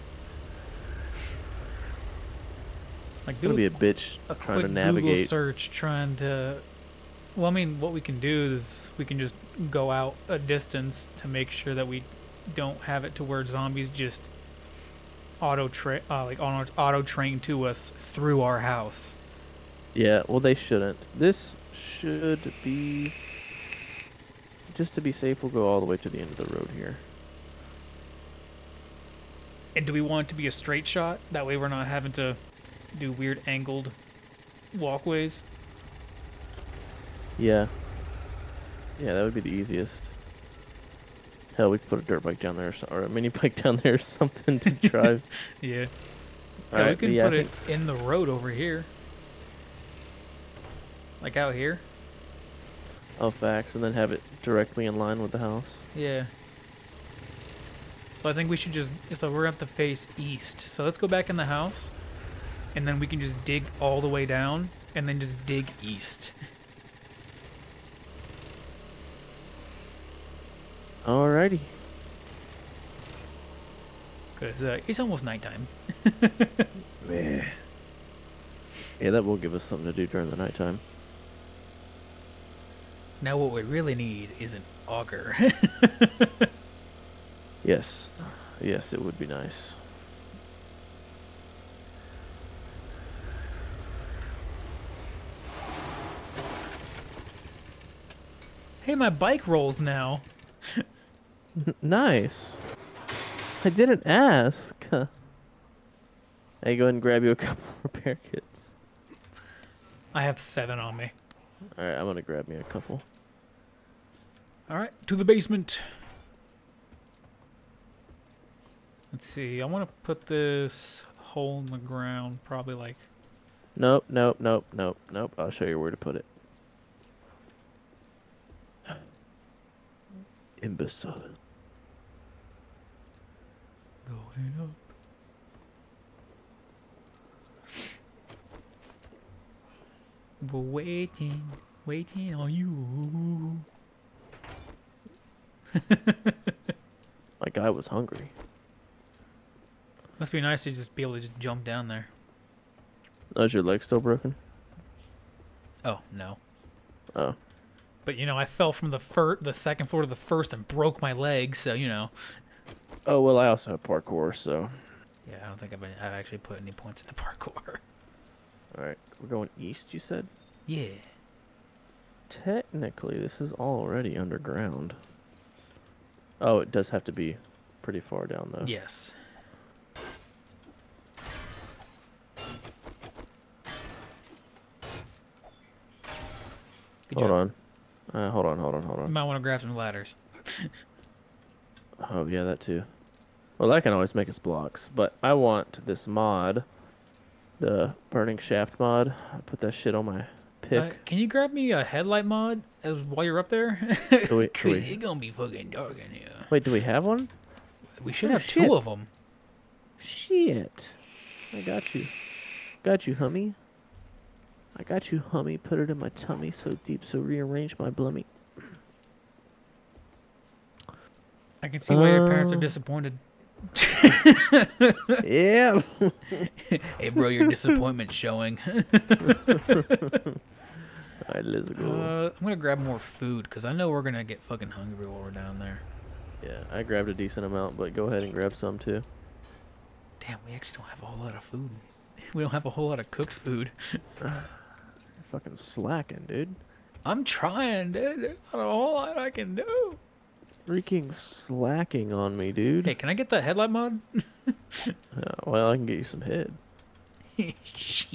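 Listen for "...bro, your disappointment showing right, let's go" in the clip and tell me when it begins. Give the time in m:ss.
3:47.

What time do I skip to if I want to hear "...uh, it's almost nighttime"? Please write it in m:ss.
1:14.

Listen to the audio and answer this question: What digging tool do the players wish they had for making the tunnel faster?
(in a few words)
An auger.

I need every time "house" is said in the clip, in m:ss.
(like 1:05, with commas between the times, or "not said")
0:18, 0:55, 1:01.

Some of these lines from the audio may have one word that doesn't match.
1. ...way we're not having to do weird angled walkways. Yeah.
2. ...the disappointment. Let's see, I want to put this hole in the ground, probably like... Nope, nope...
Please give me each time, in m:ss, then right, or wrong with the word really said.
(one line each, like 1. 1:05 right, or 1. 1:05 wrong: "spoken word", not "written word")
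1. 0:31 right
2. 1:55 wrong: "basement", not "disappointment".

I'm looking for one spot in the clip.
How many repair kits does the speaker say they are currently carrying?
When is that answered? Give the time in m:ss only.
1:50.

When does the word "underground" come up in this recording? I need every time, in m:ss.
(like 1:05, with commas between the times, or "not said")
2:54.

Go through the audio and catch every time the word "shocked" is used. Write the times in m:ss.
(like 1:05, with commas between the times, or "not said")
not said.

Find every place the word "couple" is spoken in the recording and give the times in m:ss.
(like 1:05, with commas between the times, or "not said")
1:47, 1:52.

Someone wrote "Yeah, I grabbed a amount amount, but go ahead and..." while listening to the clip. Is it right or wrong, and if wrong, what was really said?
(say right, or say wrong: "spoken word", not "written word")
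wrong: "decent", not "amount".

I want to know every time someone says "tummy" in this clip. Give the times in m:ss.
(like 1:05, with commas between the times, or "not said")
3:36.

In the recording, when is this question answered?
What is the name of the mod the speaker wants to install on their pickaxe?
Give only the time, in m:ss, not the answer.
3:18.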